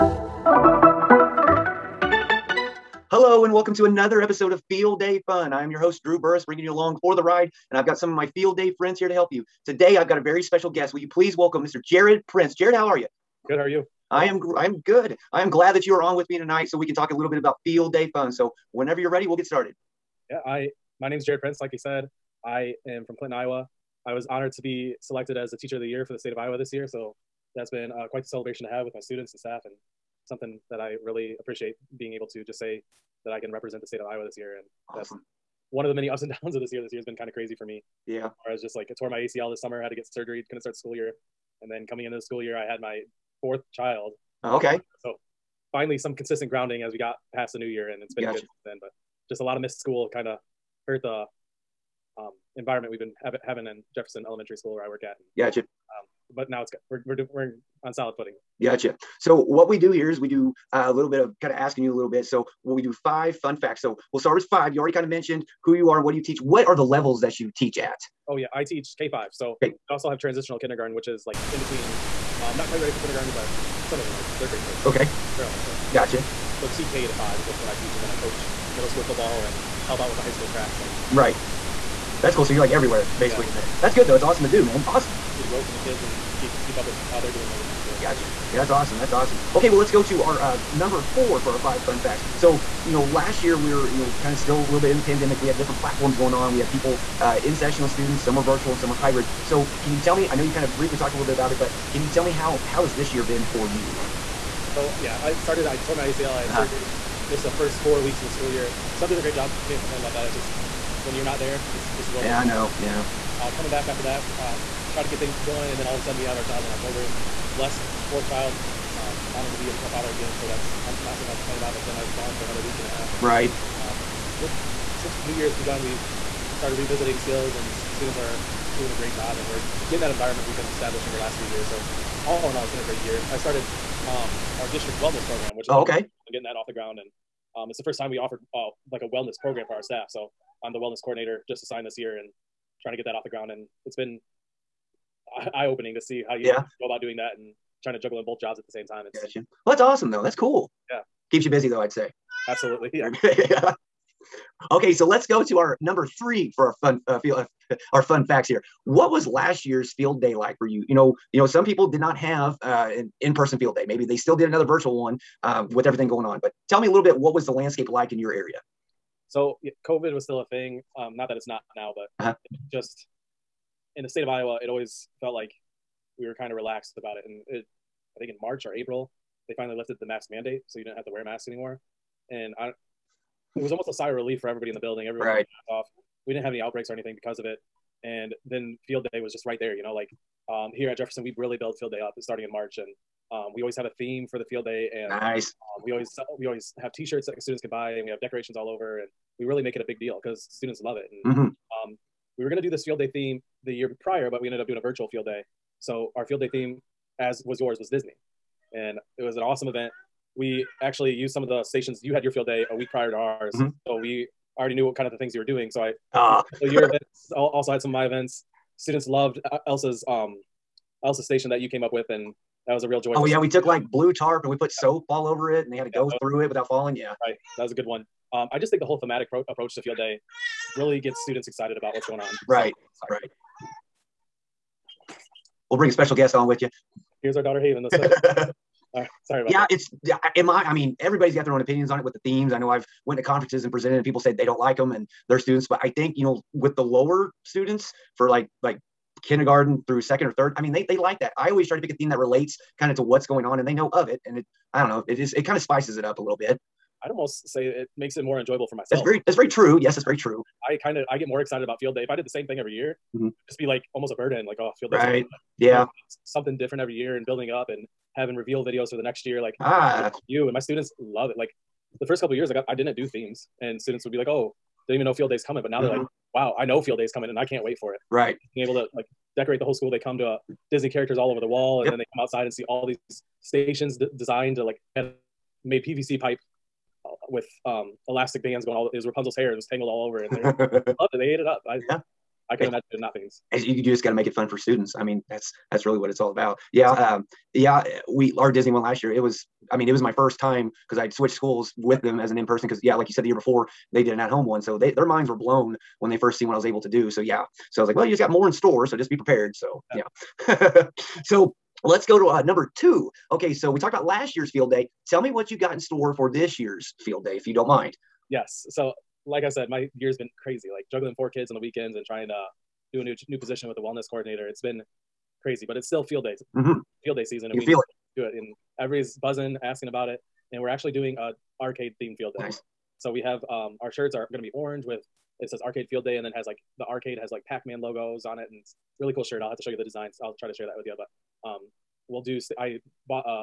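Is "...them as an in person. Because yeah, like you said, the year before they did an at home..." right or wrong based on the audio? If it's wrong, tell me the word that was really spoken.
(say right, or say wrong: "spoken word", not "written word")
right.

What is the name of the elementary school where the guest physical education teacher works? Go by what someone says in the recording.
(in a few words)
Jefferson Elementary School.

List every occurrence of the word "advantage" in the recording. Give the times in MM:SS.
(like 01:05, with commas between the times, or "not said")
not said.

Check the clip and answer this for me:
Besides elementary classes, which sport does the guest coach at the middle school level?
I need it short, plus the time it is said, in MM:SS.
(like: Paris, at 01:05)
football, at 01:19.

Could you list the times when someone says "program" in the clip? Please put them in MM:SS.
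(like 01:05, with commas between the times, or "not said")
02:15, 02:19.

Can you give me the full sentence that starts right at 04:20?
I kind of I get more excited about field day if I did the same thing every year.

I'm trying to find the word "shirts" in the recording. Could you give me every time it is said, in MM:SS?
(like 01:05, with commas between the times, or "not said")
03:16, 05:33, 05:39.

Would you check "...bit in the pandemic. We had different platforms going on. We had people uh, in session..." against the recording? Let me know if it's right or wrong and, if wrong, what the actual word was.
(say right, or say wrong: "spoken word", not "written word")
right.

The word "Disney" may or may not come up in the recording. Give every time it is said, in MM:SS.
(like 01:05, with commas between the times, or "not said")
03:27, 04:40, 04:58.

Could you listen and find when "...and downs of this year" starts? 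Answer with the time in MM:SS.
00:36.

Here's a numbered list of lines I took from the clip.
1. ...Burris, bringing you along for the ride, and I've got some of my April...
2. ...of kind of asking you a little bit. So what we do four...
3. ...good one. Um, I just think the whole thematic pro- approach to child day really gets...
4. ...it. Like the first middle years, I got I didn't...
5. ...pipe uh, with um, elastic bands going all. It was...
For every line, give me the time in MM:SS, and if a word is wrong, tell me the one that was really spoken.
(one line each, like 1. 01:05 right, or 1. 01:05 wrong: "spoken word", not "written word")
1. 00:06 wrong: "Field", not "April"
2. 01:01 wrong: "five", not "four"
3. 03:47 wrong: "field", not "child"
4. 04:31 wrong: "couple", not "middle"
5. 04:46 right.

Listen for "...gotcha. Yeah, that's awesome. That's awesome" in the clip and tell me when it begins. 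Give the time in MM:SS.
01:28.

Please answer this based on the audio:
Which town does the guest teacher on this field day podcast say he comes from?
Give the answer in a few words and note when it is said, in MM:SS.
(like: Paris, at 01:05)
Clinton, Iowa, at 00:23.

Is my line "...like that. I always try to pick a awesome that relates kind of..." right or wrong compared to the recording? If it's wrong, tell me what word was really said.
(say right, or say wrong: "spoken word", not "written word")
wrong: "theme", not "awesome".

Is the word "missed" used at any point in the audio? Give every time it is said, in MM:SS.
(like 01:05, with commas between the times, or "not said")
00:49, 01:47.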